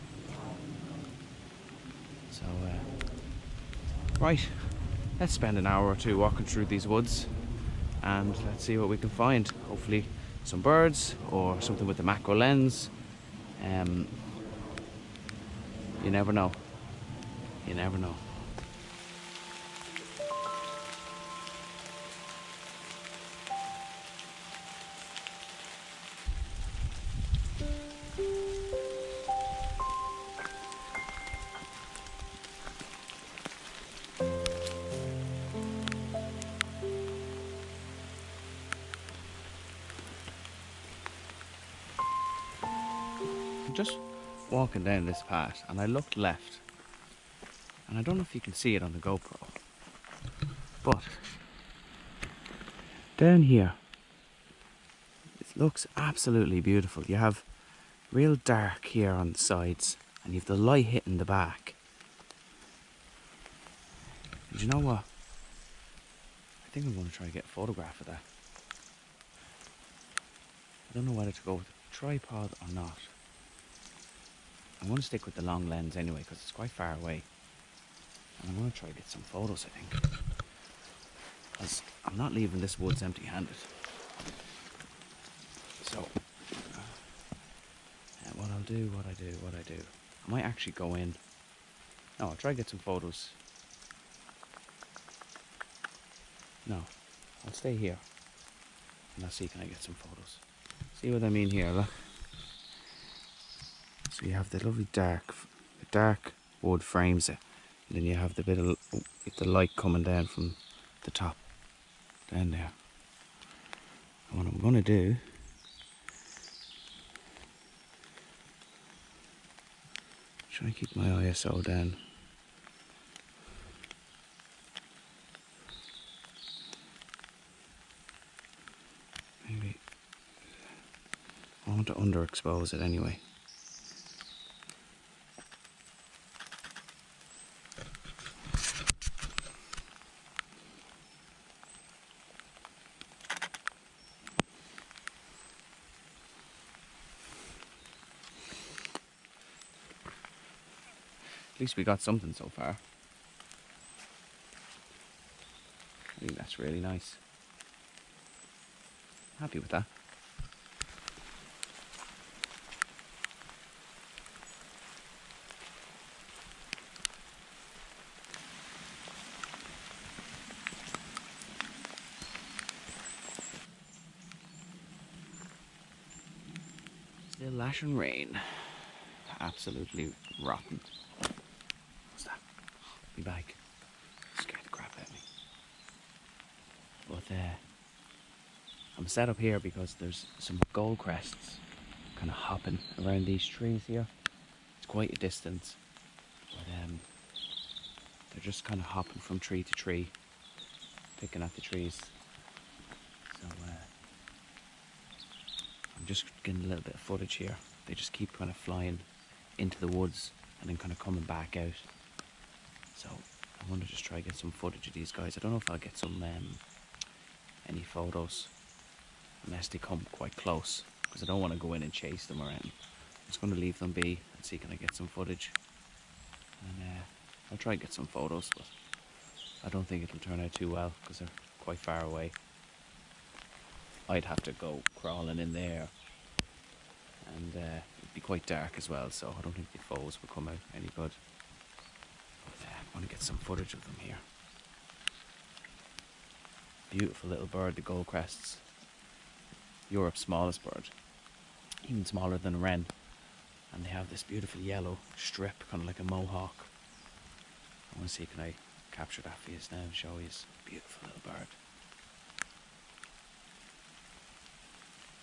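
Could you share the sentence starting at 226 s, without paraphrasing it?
And uh, I'll try and get some photos, but I don't think it'll turn out too well because they're quite far away.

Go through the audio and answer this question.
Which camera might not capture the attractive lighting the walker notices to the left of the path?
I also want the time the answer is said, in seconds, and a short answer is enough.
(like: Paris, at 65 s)
GoPro, at 48 s.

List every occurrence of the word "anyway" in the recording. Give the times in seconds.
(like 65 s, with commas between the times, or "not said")
75 s, 132 s.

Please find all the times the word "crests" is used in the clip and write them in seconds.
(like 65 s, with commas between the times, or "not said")
190 s, 248 s.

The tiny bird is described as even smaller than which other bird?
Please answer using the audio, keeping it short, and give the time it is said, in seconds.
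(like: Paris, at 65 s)
wren, at 252 s.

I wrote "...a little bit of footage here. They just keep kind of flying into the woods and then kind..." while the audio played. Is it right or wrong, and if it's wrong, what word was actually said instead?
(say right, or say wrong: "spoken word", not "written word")
right.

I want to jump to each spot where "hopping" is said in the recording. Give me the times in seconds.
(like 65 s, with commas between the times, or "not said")
192 s, 198 s.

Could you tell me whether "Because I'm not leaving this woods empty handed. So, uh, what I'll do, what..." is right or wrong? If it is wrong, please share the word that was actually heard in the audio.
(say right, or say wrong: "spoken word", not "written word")
right.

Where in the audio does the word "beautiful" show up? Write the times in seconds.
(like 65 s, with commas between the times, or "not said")
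56 s, 246 s, 254 s, 260 s.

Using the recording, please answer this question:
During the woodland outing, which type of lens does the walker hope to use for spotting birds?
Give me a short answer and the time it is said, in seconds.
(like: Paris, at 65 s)
macro lens, at 12 s.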